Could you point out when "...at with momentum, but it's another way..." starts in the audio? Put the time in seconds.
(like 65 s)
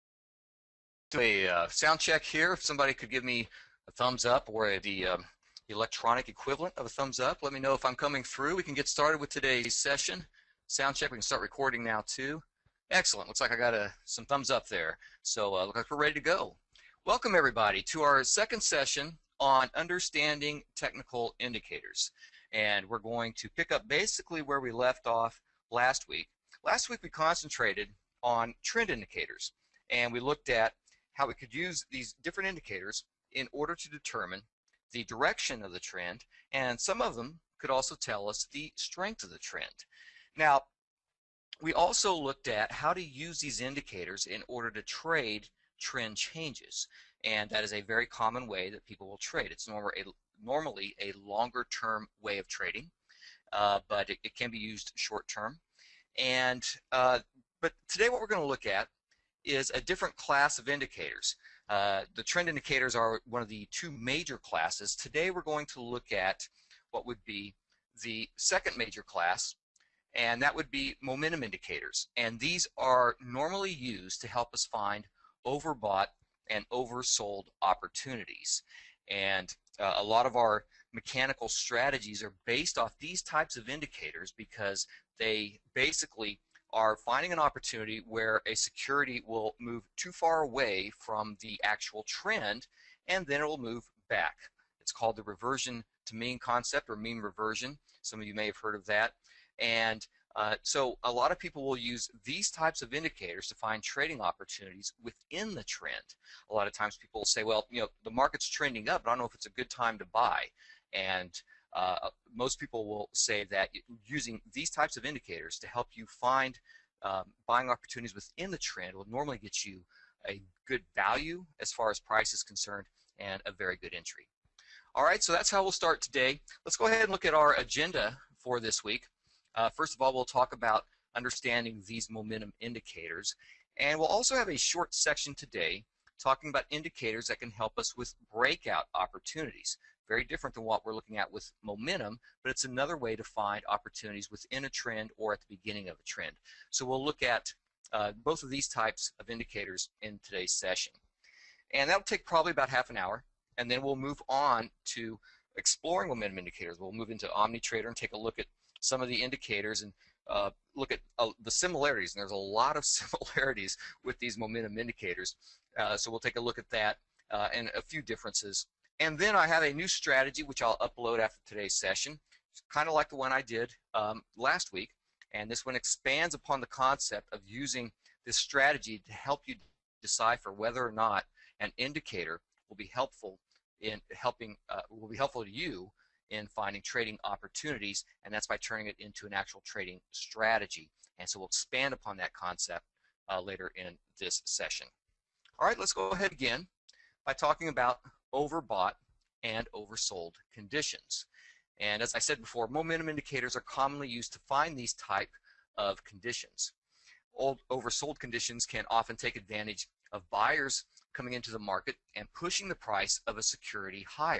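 141 s.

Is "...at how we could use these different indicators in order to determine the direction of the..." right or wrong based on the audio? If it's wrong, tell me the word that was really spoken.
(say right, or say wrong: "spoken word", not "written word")
right.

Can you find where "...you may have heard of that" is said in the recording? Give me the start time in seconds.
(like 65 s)
98 s.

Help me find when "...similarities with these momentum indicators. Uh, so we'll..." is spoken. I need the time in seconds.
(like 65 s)
162 s.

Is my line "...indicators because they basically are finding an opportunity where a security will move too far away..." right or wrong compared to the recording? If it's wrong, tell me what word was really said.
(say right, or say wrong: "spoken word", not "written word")
right.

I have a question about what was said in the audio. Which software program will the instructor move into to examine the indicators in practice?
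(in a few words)
OmniTrader.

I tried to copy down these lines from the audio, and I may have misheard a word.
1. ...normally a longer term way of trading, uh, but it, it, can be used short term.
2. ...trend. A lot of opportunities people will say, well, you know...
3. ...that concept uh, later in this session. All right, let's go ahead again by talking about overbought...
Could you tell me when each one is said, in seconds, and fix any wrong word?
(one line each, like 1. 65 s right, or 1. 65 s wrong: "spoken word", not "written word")
1. 50 s right
2. 105 s wrong: "times", not "opportunities"
3. 192 s right.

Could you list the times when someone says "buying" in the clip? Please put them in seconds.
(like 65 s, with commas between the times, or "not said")
117 s.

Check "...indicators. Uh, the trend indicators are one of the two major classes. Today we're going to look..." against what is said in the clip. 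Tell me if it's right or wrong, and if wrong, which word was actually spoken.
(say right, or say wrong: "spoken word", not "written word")
right.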